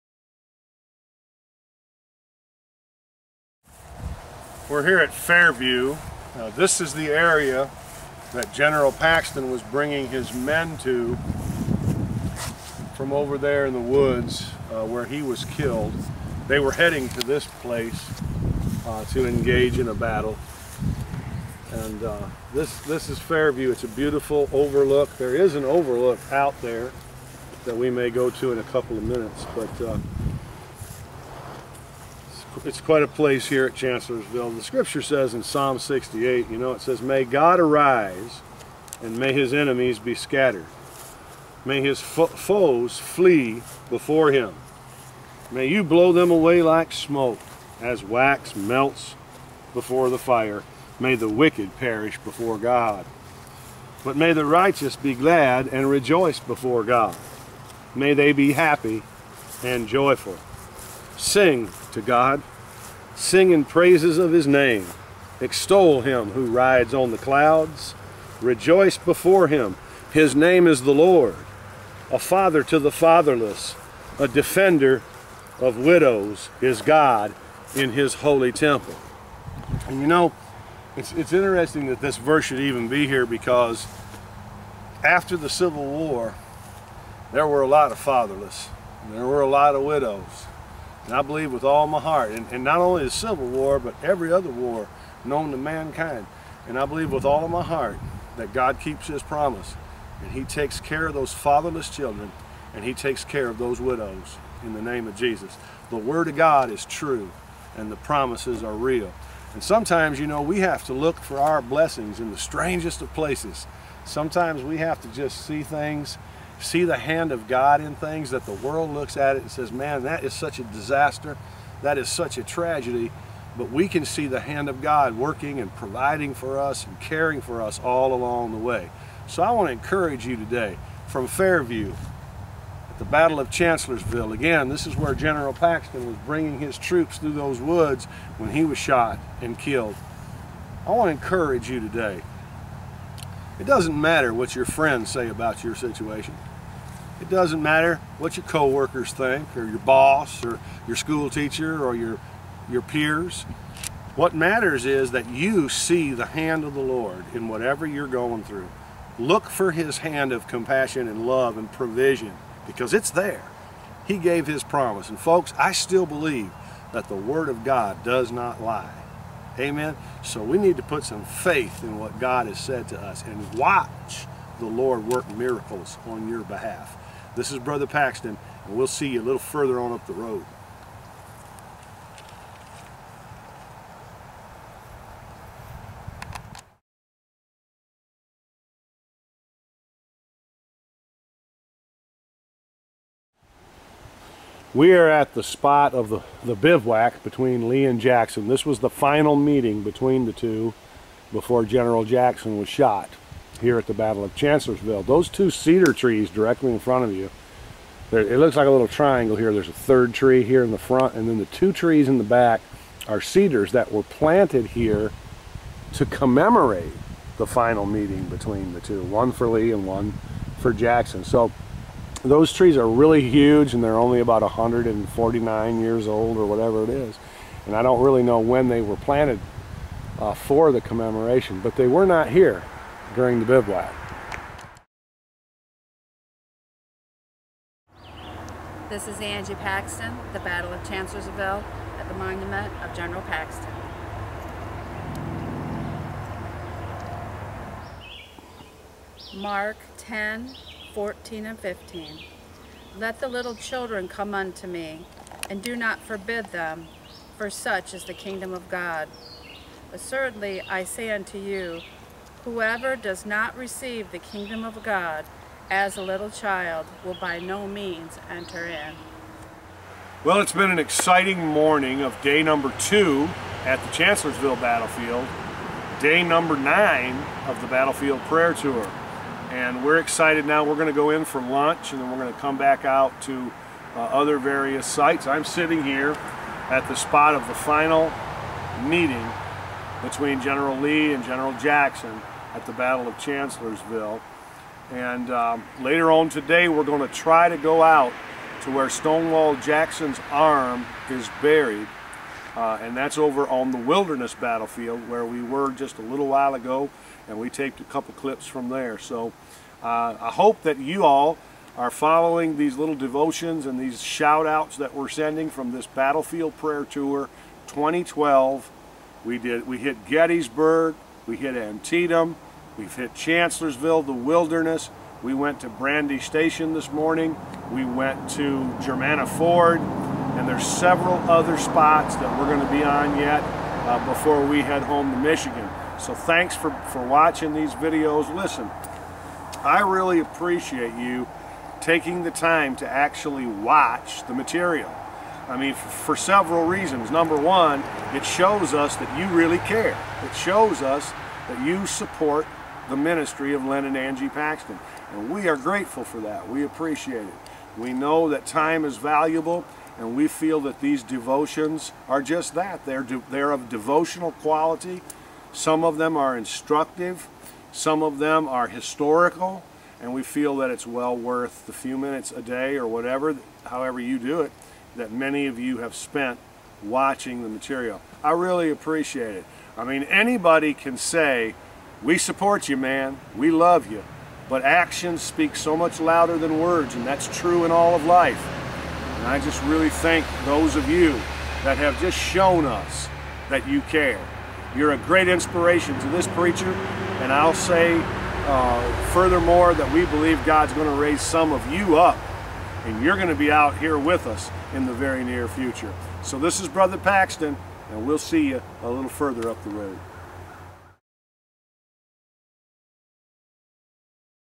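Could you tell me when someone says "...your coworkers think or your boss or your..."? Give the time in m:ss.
2:28.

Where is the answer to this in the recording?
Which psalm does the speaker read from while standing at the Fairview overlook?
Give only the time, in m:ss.
0:35.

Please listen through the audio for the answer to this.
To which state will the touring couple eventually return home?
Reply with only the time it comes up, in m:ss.
5:35.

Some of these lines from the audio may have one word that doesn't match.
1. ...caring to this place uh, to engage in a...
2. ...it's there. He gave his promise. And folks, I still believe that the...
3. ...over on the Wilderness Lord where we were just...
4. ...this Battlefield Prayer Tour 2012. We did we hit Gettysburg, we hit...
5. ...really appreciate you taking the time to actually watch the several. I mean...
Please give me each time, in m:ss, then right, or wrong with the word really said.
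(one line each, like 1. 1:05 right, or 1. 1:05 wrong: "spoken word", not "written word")
1. 0:16 wrong: "heading", not "caring"
2. 2:42 right
3. 5:03 wrong: "Battlefield", not "Lord"
4. 5:15 right
5. 5:39 wrong: "material", not "several".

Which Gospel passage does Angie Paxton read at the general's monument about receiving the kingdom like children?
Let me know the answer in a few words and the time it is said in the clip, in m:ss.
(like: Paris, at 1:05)
Mark 10:14-15, at 4:09.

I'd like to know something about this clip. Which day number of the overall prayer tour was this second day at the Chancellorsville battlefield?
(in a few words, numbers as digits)
9.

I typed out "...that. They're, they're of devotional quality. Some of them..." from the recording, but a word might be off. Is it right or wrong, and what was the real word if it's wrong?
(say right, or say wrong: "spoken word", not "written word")
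right.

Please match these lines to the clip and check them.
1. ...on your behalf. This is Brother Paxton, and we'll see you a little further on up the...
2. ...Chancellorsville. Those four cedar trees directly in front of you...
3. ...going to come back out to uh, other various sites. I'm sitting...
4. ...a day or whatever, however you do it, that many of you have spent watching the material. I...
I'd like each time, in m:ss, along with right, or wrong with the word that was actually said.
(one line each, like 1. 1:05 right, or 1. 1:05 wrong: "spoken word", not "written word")
1. 2:56 right
2. 3:24 wrong: "two", not "four"
3. 4:42 right
4. 6:12 right.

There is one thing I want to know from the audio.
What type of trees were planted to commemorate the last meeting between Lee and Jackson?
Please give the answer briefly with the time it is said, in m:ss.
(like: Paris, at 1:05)
Cedars, at 3:33.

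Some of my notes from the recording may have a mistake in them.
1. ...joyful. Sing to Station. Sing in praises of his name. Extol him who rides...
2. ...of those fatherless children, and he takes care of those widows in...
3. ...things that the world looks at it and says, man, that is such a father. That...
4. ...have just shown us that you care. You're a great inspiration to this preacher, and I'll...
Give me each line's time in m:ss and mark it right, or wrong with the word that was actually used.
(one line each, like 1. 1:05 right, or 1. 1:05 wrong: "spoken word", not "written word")
1. 0:59 wrong: "God", not "Station"
2. 1:41 right
3. 1:57 wrong: "disaster", not "father"
4. 6:31 right.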